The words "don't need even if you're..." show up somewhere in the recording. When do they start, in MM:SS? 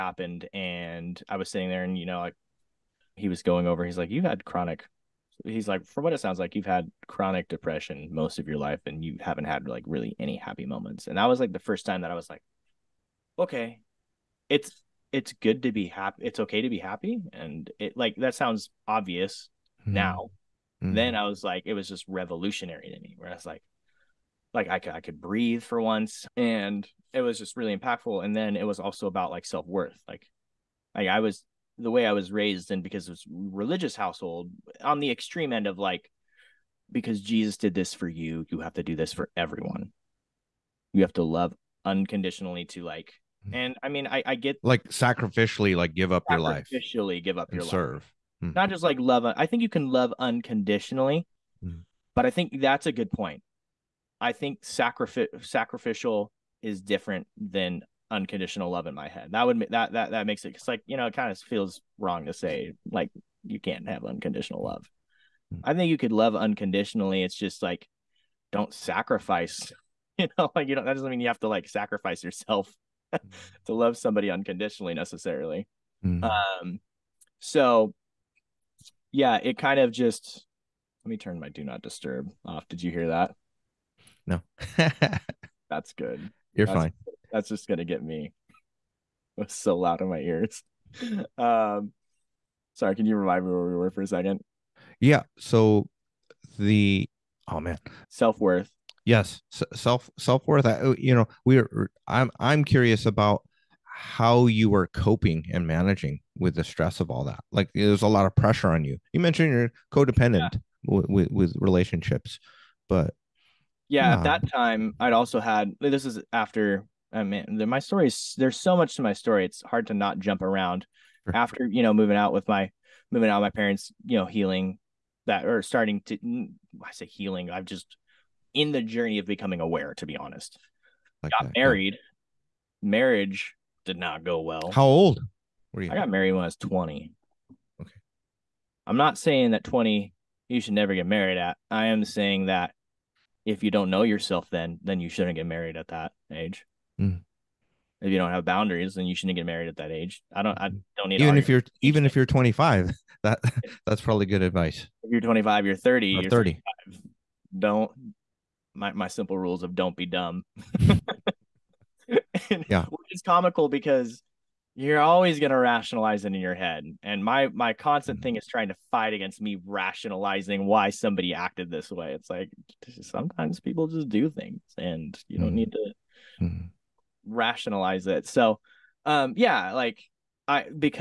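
02:30.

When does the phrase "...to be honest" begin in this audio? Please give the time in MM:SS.
02:09.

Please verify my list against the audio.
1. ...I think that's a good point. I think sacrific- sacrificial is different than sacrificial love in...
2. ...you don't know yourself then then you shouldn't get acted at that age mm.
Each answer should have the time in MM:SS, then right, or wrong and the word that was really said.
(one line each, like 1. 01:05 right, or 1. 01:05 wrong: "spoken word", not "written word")
1. 00:52 wrong: "unconditional", not "sacrificial"
2. 02:23 wrong: "married", not "acted".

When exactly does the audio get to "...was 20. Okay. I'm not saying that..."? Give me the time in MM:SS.
02:16.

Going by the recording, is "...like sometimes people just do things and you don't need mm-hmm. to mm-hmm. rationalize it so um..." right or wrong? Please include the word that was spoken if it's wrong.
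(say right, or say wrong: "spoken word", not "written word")
right.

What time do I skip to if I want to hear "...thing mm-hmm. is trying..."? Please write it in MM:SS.
02:48.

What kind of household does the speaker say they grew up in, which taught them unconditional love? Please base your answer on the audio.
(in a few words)
Religious.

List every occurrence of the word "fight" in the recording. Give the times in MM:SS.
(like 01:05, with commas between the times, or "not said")
02:48.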